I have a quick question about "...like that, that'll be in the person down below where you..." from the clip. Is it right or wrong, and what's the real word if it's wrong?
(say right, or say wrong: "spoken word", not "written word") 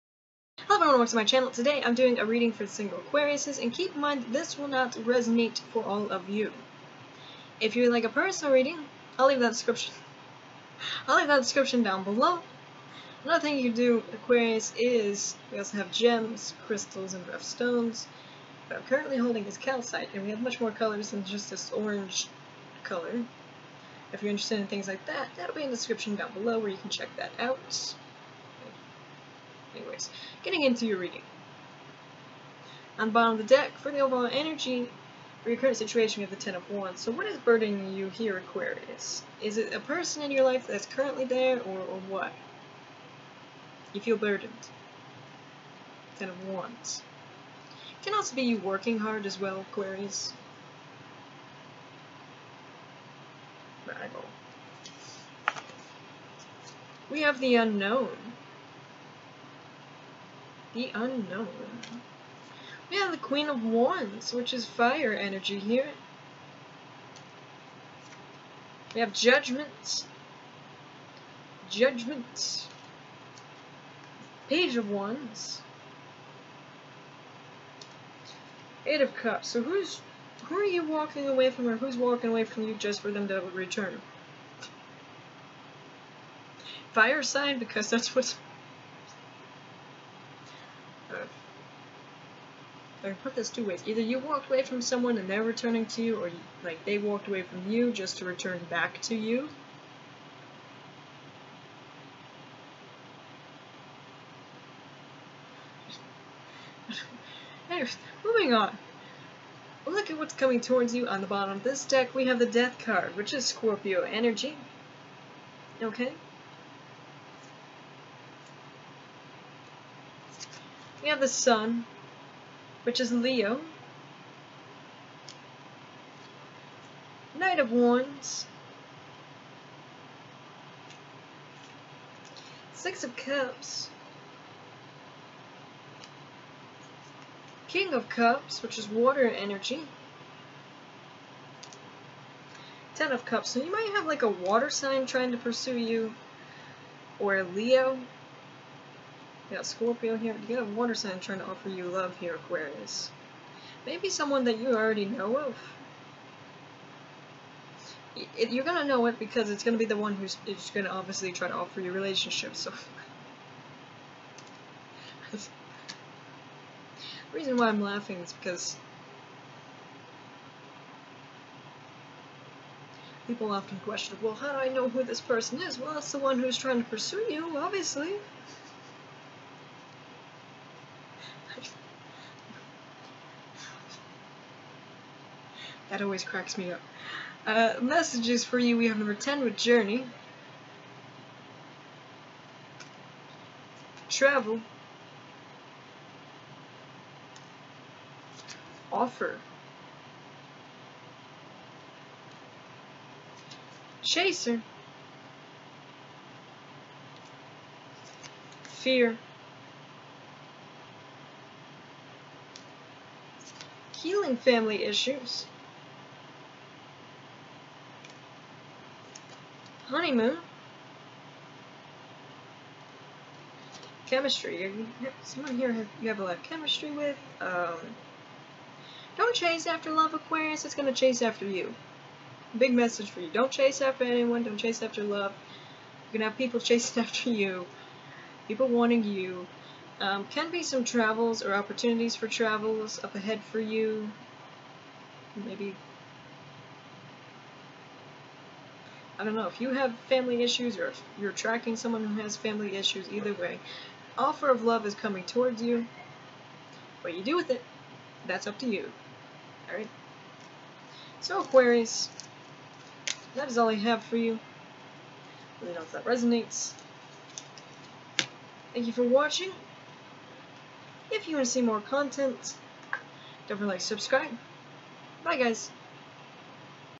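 wrong: "description", not "person".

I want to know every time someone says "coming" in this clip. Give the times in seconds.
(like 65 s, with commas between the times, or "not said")
110 s, 254 s.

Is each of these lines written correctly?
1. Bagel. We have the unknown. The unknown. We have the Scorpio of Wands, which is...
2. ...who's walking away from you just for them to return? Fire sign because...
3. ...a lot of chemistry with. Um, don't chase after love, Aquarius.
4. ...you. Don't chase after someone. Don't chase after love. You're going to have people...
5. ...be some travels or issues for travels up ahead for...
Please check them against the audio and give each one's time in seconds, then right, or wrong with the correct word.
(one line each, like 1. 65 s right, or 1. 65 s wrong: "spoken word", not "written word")
1. 53 s wrong: "Queen", not "Scorpio"
2. 81 s right
3. 226 s right
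4. 233 s wrong: "anyone", not "someone"
5. 240 s wrong: "opportunities", not "issues".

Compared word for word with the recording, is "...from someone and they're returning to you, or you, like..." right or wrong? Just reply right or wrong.
right.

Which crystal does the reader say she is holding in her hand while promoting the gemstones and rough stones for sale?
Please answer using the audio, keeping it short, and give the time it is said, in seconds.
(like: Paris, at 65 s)
Calcite, at 19 s.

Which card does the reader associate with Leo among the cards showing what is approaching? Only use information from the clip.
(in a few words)
The Sun.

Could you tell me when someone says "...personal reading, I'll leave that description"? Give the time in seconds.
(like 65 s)
8 s.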